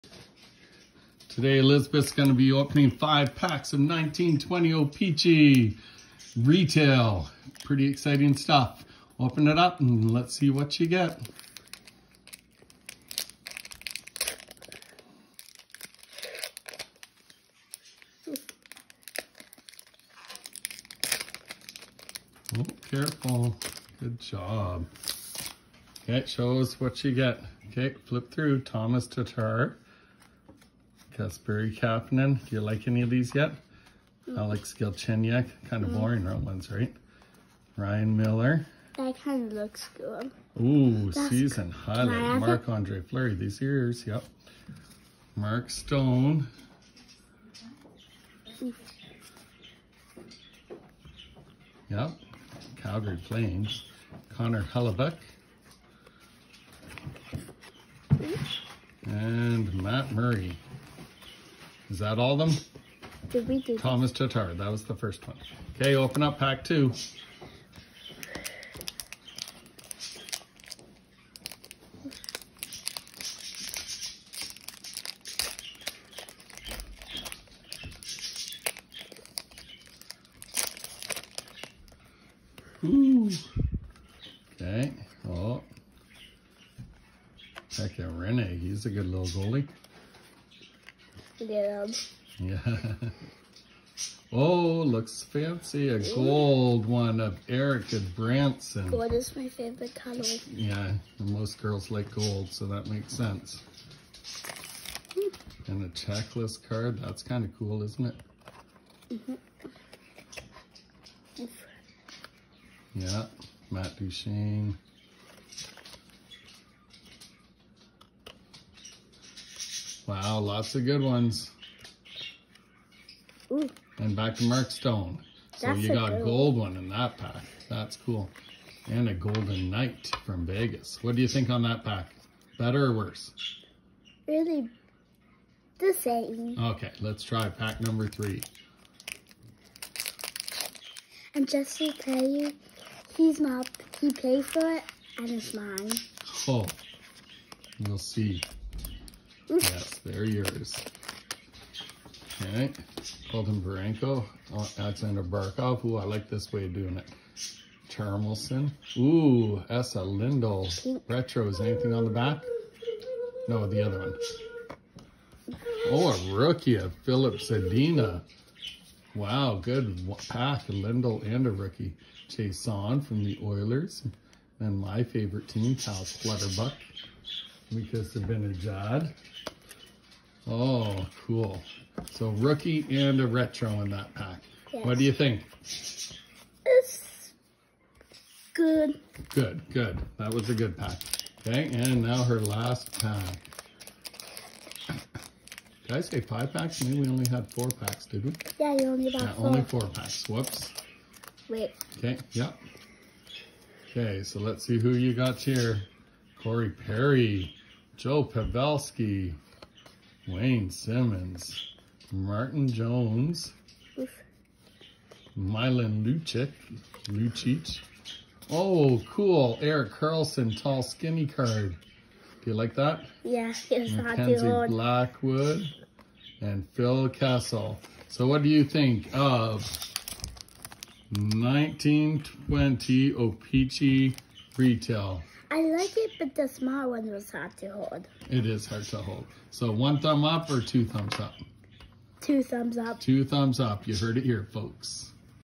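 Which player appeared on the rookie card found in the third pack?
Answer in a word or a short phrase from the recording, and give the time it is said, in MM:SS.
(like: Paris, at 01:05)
Filip Zadina, at 02:47.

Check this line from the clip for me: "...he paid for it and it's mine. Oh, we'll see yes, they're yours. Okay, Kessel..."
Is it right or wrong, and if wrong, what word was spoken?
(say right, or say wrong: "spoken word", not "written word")
wrong: "Colton", not "Kessel".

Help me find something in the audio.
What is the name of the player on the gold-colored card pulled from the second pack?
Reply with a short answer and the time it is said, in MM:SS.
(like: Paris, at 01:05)
Erica Branson, at 01:37.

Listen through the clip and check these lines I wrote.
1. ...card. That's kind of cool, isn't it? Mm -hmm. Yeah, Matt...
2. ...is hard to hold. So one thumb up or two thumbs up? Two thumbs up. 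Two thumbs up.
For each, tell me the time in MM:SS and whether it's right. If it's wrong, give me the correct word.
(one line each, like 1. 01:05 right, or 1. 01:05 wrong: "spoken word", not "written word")
1. 01:46 right
2. 03:58 right.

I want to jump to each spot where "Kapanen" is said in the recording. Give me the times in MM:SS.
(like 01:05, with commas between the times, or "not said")
00:31.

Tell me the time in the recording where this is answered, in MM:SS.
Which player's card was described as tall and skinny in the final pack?
03:39.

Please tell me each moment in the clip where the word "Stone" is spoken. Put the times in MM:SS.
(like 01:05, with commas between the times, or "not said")
00:45, 02:04.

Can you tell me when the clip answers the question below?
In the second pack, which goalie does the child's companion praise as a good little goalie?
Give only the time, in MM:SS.
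01:28.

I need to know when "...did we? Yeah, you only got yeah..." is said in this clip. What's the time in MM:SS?
03:18.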